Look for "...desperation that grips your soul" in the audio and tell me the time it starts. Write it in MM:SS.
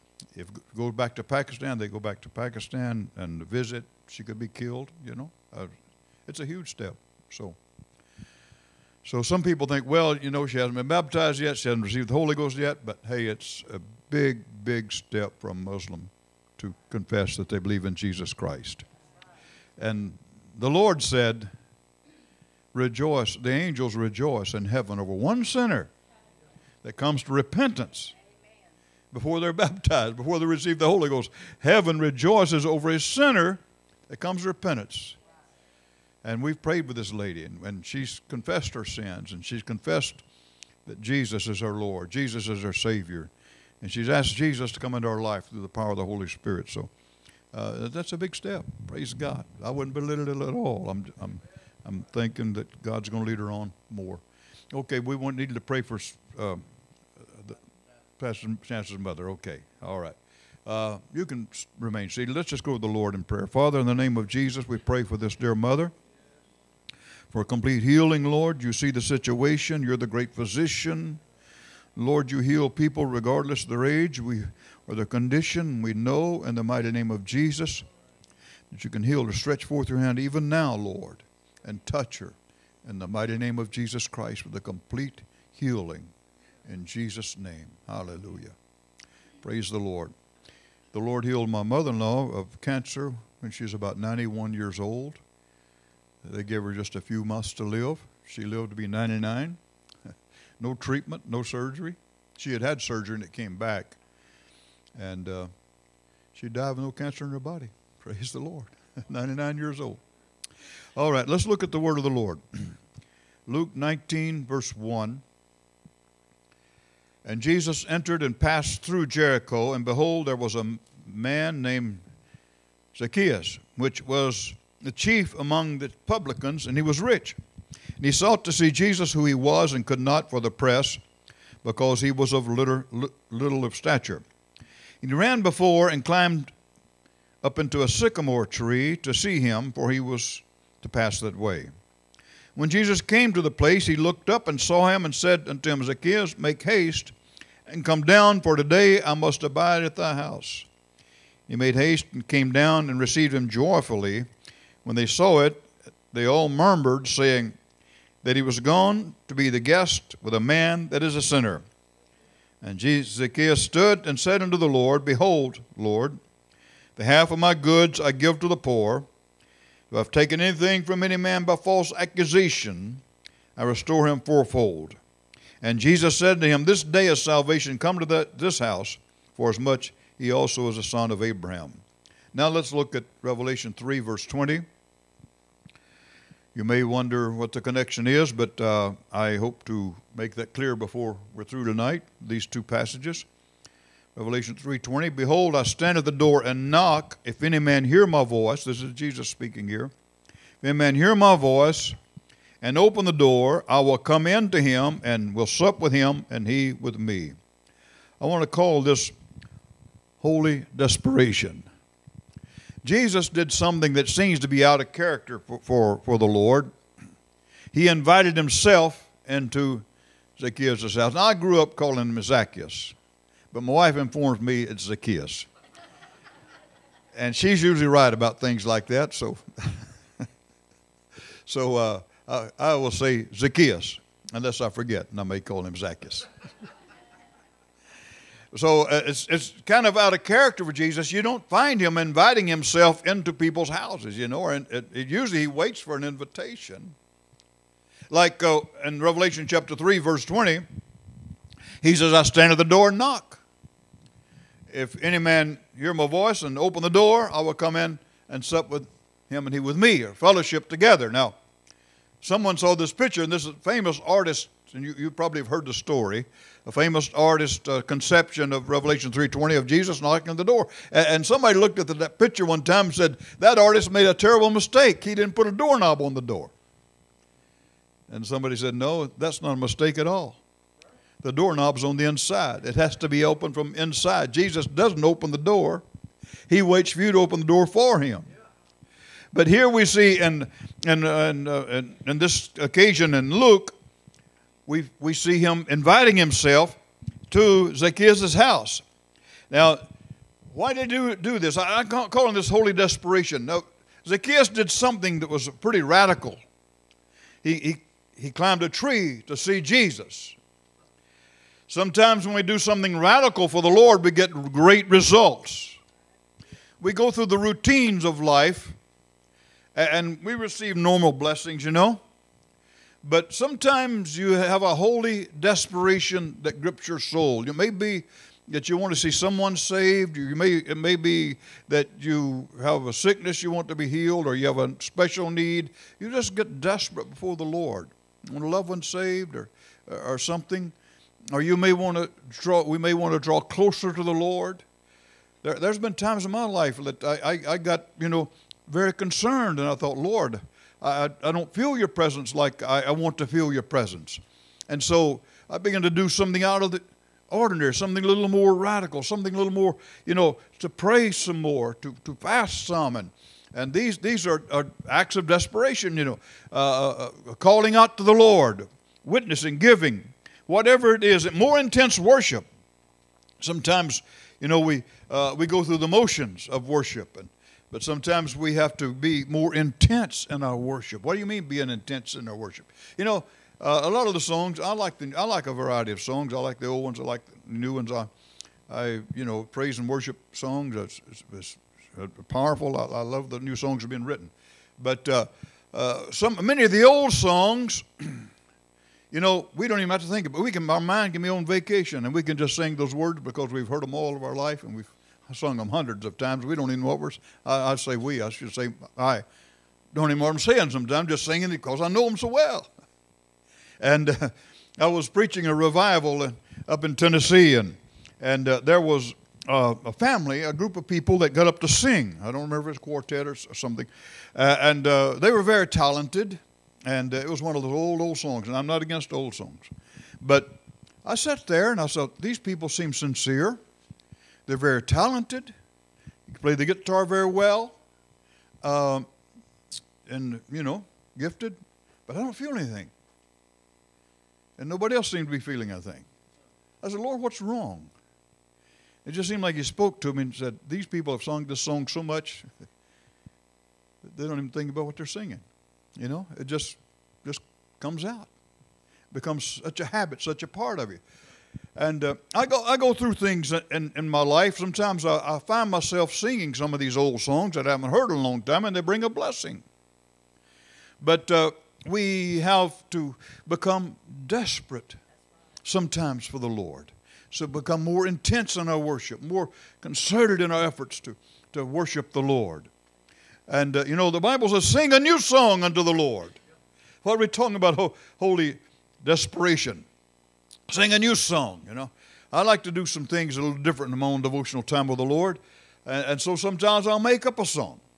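05:25.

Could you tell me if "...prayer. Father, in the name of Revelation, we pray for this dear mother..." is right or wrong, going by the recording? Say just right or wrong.
wrong.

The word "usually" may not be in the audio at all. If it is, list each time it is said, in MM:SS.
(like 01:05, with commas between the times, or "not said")
03:47, 04:05.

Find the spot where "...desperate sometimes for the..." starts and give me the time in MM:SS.
07:54.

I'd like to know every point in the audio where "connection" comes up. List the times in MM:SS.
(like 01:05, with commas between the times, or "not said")
03:07.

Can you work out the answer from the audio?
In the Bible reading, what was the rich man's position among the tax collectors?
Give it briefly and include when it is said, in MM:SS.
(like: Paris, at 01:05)
Chief among the publicans, at 02:04.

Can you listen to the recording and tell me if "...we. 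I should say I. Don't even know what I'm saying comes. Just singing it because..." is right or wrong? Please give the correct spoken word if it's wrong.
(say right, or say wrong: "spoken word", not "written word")
wrong: "sometimes", not "comes".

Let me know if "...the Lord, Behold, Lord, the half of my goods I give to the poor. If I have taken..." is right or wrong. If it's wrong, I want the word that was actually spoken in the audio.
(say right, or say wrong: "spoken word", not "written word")
right.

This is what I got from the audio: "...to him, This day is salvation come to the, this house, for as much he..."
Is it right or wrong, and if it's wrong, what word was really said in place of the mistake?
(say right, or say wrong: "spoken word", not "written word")
right.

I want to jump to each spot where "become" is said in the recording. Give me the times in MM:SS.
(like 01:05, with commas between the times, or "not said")
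07:39, 07:53, 07:57.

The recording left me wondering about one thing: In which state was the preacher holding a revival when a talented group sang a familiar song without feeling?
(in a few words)
Tennessee.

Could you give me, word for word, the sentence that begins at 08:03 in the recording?
And uh, you know, the Bible says, sing a new song unto the Lord.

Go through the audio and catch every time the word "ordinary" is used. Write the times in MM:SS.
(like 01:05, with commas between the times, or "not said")
05:57.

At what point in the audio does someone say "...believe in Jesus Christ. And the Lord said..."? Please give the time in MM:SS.
00:17.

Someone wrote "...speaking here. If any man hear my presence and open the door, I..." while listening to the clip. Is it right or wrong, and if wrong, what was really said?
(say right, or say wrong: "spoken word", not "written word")
wrong: "voice", not "presence".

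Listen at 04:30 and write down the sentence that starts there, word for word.
And, and somebody looked at the, that picture one time and said, that artist made a terrible mistake.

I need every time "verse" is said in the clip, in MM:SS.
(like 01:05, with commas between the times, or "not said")
01:54, 03:04, 04:09.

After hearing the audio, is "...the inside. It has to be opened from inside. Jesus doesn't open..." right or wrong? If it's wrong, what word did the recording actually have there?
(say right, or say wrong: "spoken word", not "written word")
right.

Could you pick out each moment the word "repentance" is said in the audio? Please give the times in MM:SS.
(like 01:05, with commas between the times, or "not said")
00:27, 00:34.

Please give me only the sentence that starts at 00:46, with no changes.
So uh, that's a big step.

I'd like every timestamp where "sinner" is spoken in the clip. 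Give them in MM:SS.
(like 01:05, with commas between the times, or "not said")
00:25, 00:33, 02:41.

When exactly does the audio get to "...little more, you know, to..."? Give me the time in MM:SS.
05:59.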